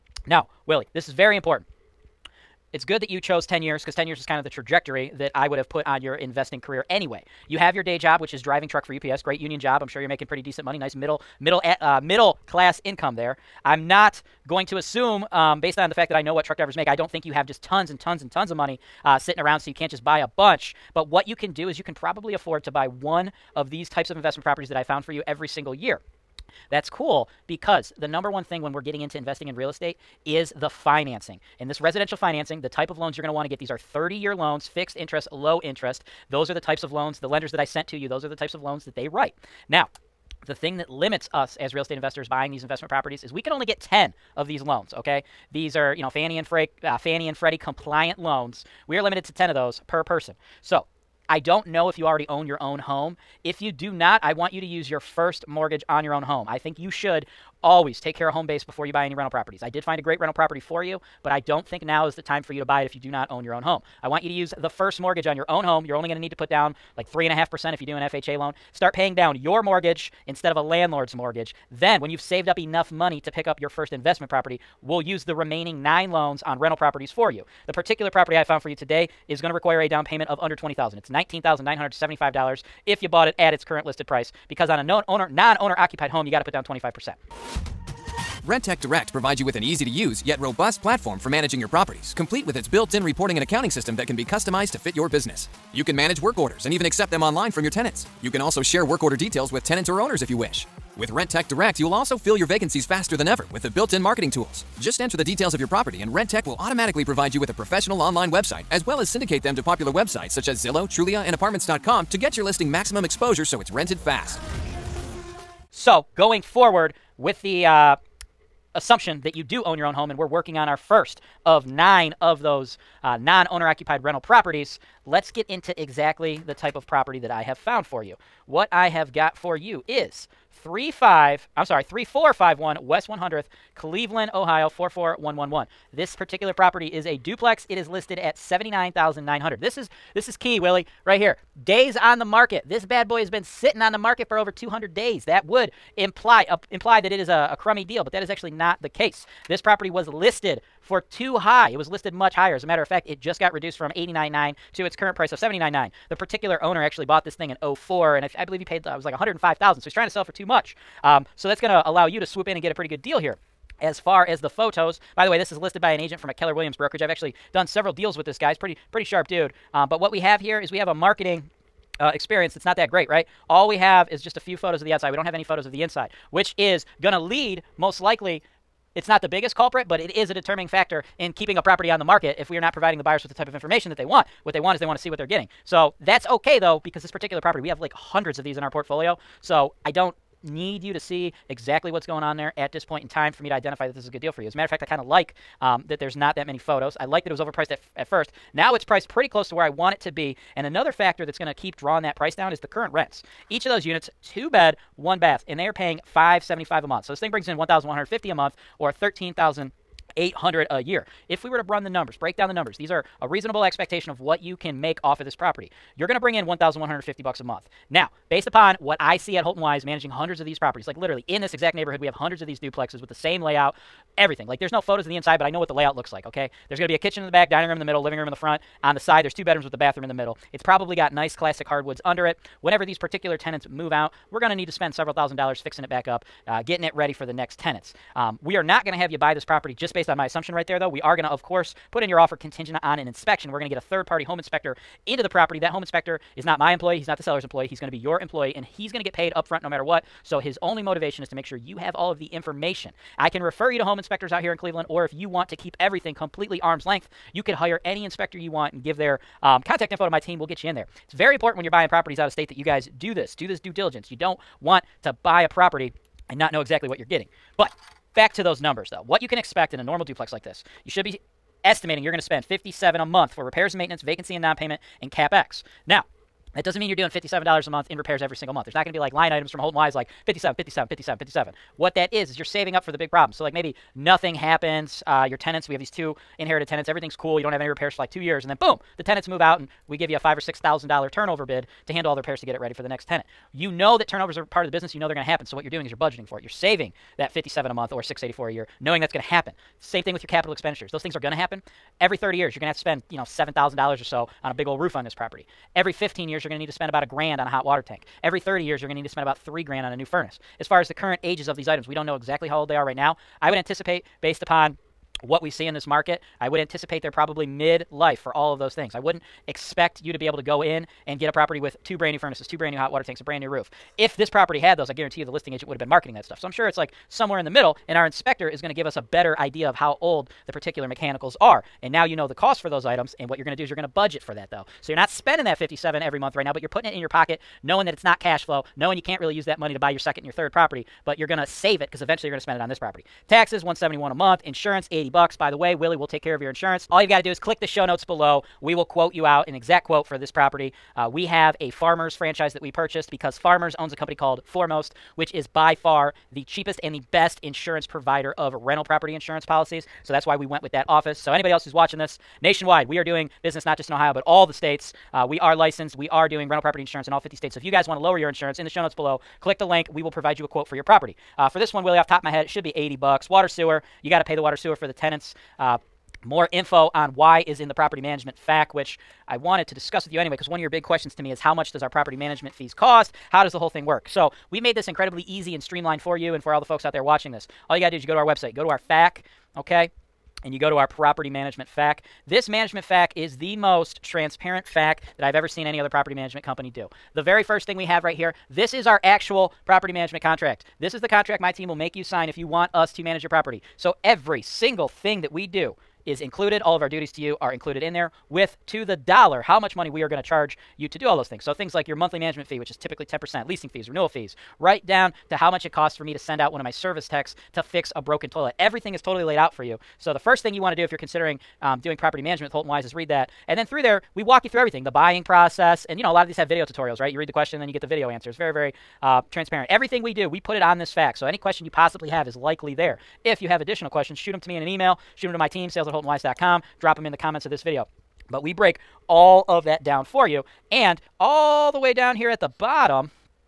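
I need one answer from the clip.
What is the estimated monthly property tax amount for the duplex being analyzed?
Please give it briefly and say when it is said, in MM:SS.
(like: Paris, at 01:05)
171, at 05:43.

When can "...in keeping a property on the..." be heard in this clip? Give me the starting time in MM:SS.
03:01.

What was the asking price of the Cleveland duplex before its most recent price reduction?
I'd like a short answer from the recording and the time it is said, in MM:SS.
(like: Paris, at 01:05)
89.9, at 02:33.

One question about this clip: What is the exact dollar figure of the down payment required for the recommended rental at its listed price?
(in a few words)
$19,975.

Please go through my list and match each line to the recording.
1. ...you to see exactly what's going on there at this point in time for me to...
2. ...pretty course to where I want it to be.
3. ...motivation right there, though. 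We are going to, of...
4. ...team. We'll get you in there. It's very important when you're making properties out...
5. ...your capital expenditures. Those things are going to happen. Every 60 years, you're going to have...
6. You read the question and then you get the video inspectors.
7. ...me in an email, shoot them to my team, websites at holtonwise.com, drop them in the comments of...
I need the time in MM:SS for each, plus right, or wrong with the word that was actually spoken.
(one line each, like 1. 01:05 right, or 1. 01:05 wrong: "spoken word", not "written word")
1. 03:10 right
2. 03:19 wrong: "close", not "course"
3. 04:00 wrong: "assumption", not "motivation"
4. 04:20 wrong: "buying", not "making"
5. 05:00 wrong: "30", not "60"
6. 07:07 wrong: "answers", not "inspectors"
7. 07:14 wrong: "sales", not "websites".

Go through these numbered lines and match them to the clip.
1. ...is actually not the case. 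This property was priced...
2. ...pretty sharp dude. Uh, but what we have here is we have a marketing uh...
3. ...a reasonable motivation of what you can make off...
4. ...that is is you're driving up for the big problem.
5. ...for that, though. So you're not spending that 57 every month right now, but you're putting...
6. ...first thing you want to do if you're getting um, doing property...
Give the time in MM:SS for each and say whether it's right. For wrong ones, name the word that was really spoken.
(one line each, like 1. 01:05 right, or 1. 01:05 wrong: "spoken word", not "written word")
1. 02:28 wrong: "listed", not "priced"
2. 02:48 right
3. 03:33 wrong: "expectation", not "motivation"
4. 04:41 wrong: "saving", not "driving"
5. 05:34 right
6. 07:00 wrong: "considering", not "getting".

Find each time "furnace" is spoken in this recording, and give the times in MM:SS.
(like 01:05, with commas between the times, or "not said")
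05:10, 05:22.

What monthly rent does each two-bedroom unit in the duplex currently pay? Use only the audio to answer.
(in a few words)
575.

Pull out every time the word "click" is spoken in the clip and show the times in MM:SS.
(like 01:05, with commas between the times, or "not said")
05:47, 06:09.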